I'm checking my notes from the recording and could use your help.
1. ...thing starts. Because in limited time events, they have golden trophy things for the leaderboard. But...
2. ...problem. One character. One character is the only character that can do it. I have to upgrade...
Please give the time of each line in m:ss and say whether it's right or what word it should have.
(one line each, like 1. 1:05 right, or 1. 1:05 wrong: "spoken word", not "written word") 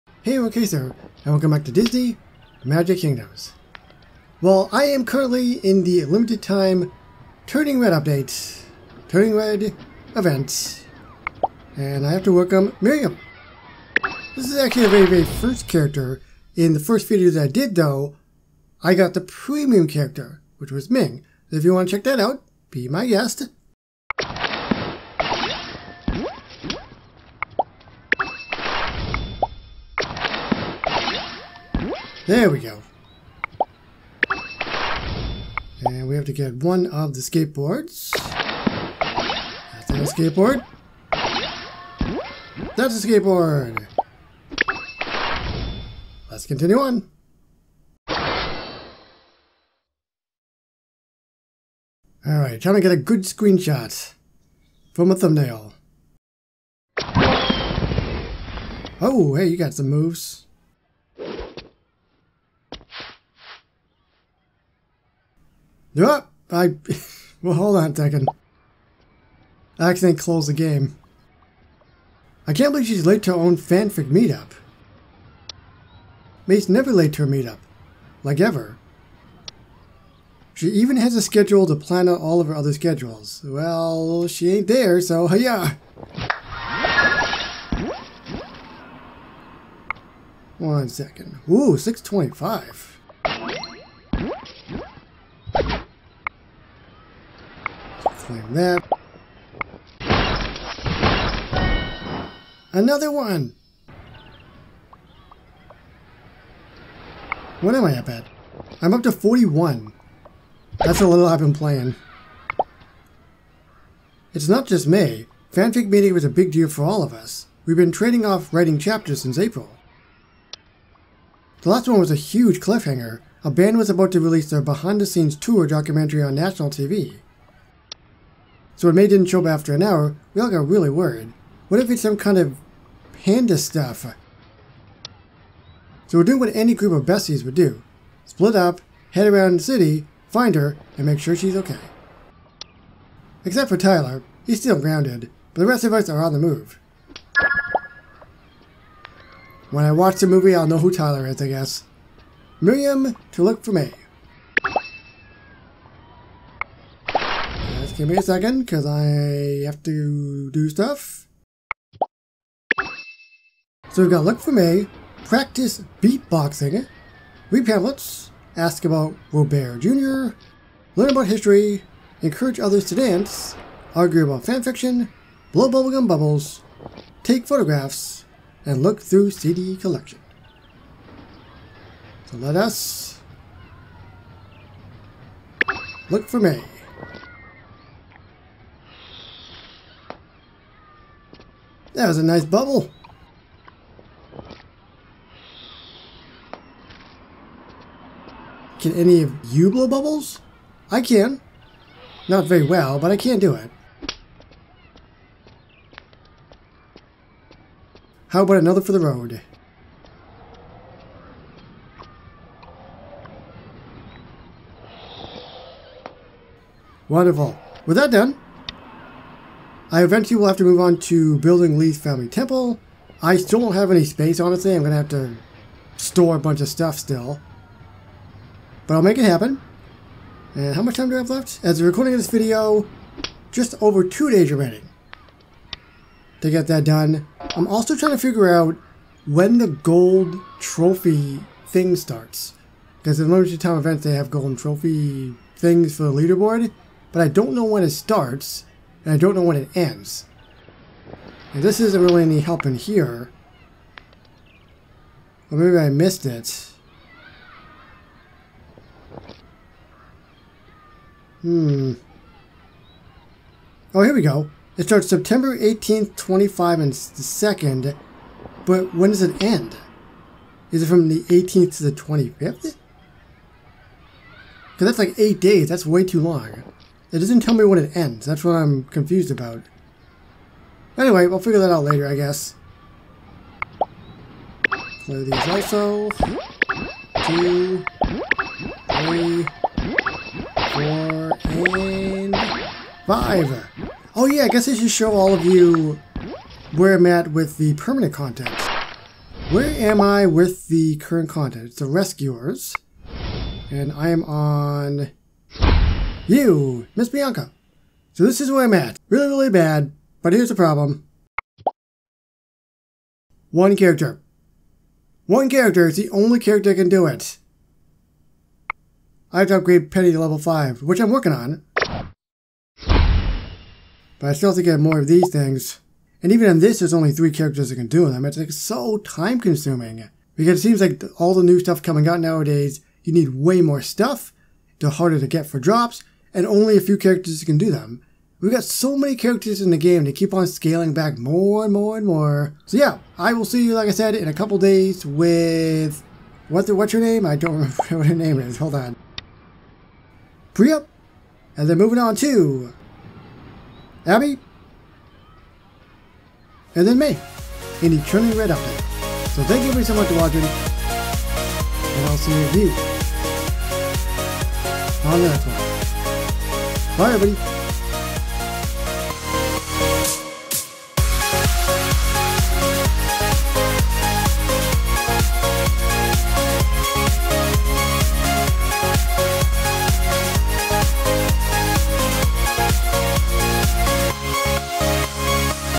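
1. 4:01 right
2. 5:10 right.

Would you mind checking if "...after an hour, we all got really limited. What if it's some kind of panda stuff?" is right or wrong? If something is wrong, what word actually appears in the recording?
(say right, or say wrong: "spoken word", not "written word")
wrong: "worried", not "limited".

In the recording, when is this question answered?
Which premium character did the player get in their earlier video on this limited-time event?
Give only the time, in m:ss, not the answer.
0:20.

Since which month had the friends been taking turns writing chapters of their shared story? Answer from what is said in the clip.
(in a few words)
April.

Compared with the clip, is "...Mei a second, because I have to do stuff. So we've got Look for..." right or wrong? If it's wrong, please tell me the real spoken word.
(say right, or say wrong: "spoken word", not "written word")
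right.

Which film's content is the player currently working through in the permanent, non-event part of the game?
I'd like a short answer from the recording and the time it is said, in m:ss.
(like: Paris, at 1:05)
The Rescuers, at 5:01.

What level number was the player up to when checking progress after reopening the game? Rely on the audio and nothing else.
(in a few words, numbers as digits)
41.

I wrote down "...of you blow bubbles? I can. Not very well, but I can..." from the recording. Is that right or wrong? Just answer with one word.
right.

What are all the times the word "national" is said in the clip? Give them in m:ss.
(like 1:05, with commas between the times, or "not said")
2:06.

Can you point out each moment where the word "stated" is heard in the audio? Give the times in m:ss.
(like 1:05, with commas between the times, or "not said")
not said.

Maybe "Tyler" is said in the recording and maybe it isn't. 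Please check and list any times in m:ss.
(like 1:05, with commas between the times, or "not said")
2:23, 2:30.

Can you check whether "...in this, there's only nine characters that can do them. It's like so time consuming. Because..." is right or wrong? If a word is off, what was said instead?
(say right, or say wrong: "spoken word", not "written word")
wrong: "three", not "nine".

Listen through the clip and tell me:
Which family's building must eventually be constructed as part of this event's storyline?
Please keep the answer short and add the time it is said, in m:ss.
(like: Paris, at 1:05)
Lee's family temple, at 3:41.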